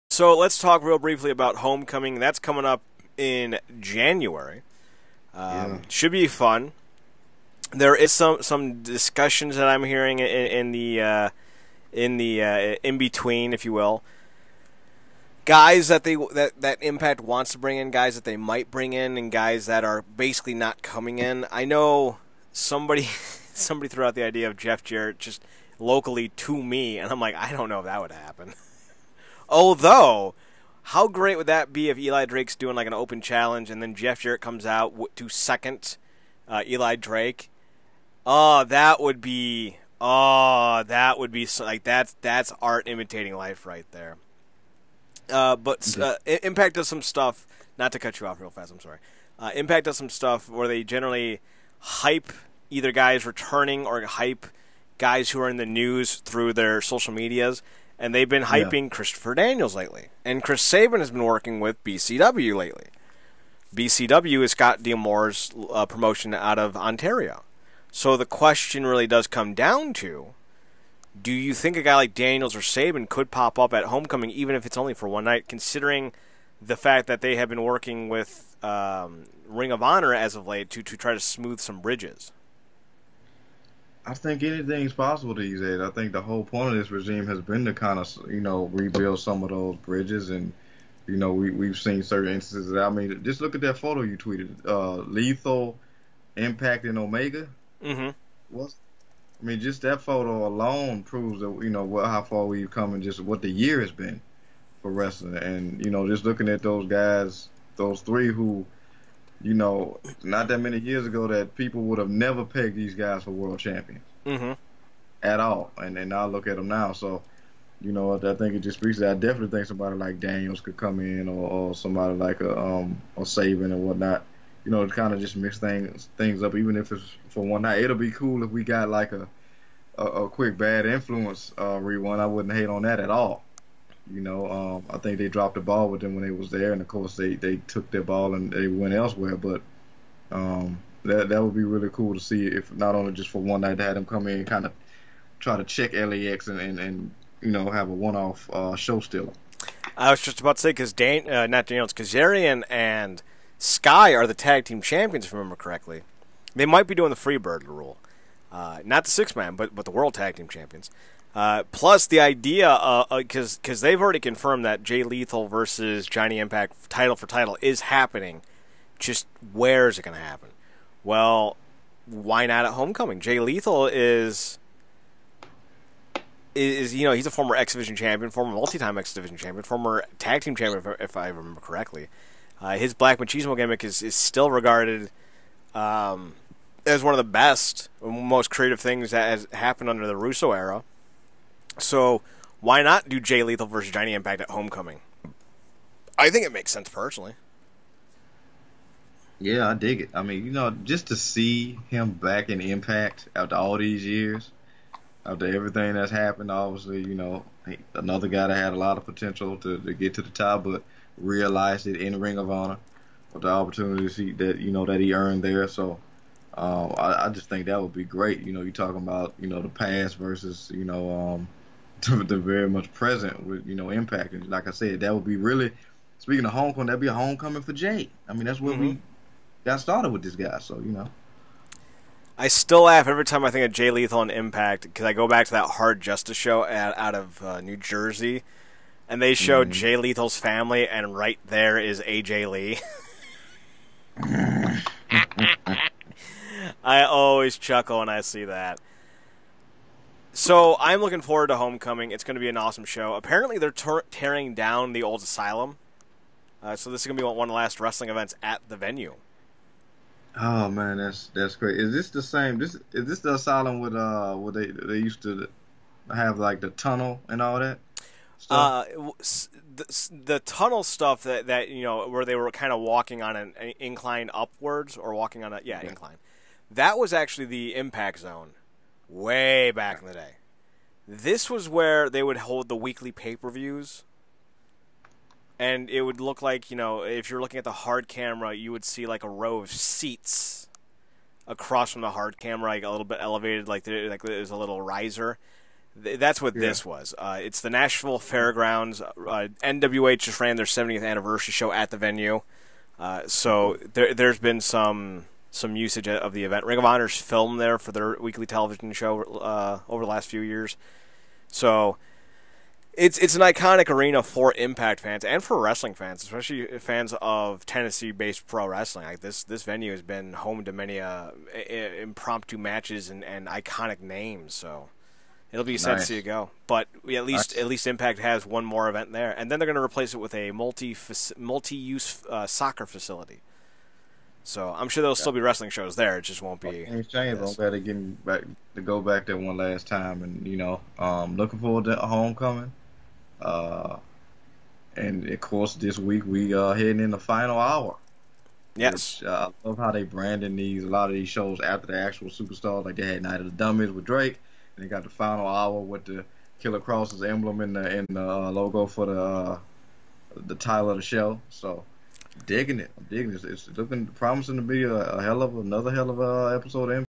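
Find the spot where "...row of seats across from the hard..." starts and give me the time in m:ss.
4:49.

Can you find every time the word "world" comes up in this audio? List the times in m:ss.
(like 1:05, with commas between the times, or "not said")
1:53, 2:39.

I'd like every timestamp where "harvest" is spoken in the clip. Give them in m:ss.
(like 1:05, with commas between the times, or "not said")
not said.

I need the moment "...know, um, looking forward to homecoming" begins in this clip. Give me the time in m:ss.
5:40.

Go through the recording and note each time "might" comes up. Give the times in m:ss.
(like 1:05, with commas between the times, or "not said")
0:18, 2:36.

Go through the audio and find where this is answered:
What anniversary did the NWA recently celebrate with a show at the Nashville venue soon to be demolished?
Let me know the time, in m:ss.
5:00.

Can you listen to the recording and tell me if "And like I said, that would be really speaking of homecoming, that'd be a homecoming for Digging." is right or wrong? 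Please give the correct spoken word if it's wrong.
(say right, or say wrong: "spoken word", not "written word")
wrong: "Jay", not "Digging".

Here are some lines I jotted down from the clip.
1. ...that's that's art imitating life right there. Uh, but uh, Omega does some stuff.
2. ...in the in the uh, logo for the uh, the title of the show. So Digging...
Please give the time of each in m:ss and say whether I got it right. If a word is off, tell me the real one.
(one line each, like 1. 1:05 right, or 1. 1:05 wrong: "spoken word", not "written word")
1. 0:41 wrong: "Impact", not "Omega"
2. 5:57 right.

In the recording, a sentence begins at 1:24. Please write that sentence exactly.
I think anything's possible these days.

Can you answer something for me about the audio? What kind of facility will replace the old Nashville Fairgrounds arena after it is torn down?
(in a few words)
soccer facility.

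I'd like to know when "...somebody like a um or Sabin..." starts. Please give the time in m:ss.
2:01.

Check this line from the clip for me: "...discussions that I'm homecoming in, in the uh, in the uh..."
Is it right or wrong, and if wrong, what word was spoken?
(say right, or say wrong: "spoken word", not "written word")
wrong: "hearing", not "homecoming".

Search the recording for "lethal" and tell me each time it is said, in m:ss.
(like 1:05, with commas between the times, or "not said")
1:35, 2:45, 2:53, 3:13, 3:53, 3:59.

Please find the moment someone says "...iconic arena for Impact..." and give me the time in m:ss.
5:13.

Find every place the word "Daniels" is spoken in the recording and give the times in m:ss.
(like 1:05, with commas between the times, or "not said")
0:59, 1:12, 2:00, 2:31.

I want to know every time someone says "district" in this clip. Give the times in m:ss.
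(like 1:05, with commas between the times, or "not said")
not said.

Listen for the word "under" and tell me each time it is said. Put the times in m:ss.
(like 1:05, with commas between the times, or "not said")
3:09.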